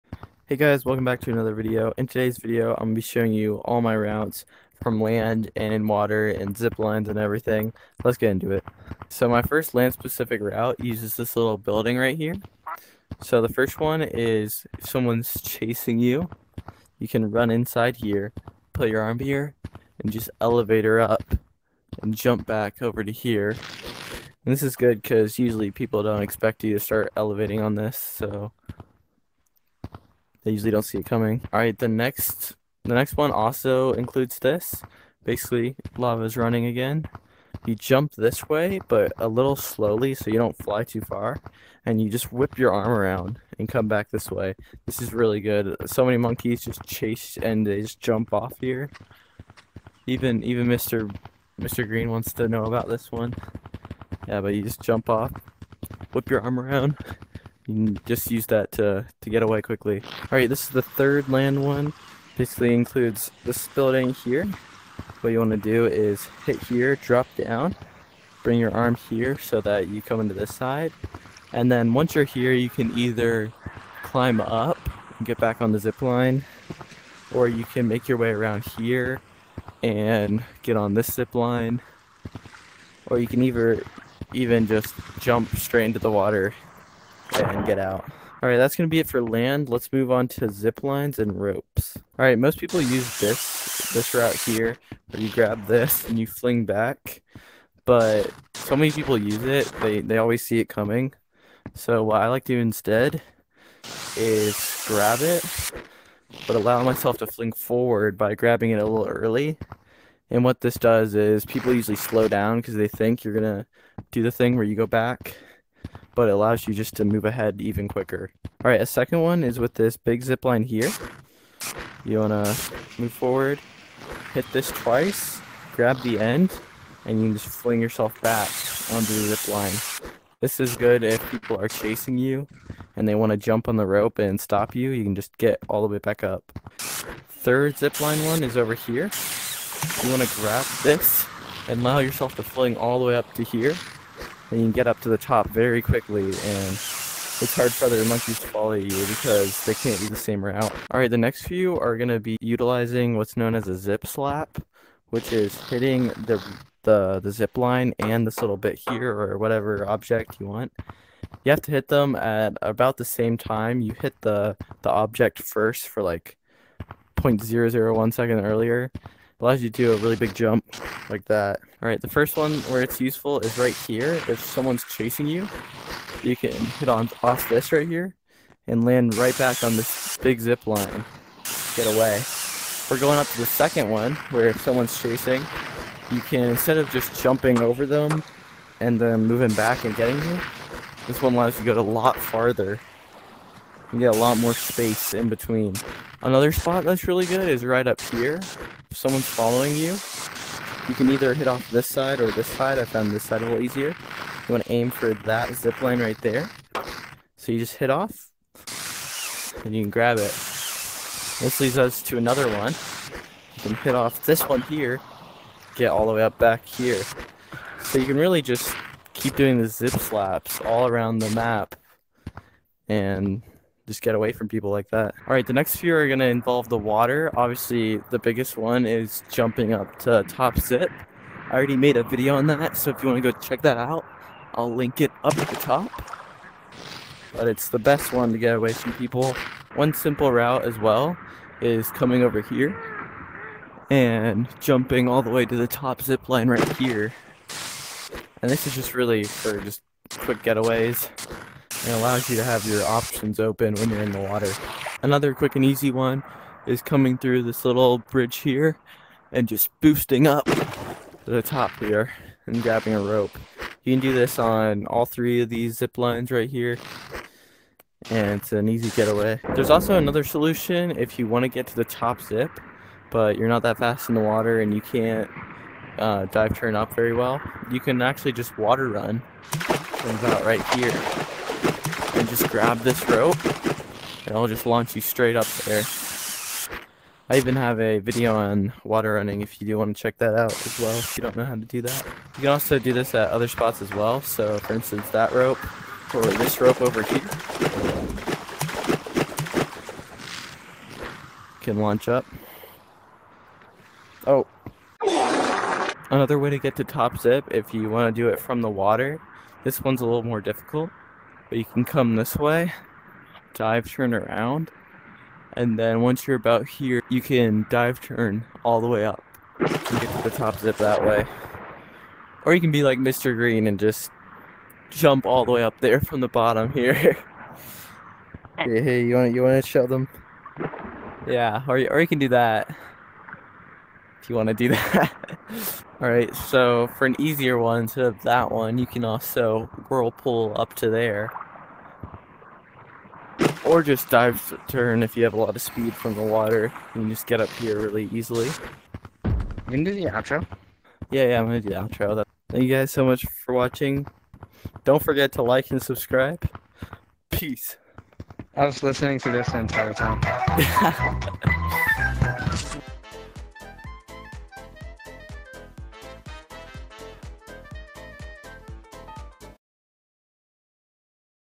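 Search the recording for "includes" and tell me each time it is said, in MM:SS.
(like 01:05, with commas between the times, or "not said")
00:33, 01:02.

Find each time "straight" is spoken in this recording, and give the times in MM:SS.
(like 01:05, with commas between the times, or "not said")
01:25, 04:45.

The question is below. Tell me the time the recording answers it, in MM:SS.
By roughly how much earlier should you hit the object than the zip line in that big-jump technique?
02:47.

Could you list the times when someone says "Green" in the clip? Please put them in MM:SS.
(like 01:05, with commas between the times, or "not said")
00:51, 05:23.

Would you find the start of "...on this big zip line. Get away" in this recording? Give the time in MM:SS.
02:59.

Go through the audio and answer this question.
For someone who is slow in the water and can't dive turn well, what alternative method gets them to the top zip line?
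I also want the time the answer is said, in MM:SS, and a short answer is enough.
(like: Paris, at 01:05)
water run, at 04:38.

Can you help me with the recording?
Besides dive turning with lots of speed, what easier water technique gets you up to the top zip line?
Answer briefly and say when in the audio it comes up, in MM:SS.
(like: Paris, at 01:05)
whirlpool, at 05:39.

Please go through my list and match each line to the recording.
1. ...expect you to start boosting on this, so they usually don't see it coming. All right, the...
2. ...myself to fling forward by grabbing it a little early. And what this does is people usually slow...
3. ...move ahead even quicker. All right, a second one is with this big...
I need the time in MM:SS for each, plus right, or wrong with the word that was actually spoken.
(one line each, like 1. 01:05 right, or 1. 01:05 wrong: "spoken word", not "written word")
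1. 00:26 wrong: "elevating", not "boosting"
2. 01:46 right
3. 01:57 right.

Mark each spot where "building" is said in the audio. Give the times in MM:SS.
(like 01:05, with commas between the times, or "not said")
00:11, 01:03.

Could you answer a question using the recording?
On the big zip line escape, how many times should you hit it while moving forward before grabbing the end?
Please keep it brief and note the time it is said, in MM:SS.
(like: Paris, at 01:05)
2, at 02:04.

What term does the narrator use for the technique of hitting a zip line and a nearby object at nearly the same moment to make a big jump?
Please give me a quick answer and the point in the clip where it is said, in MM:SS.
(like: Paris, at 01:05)
zip slap, at 02:33.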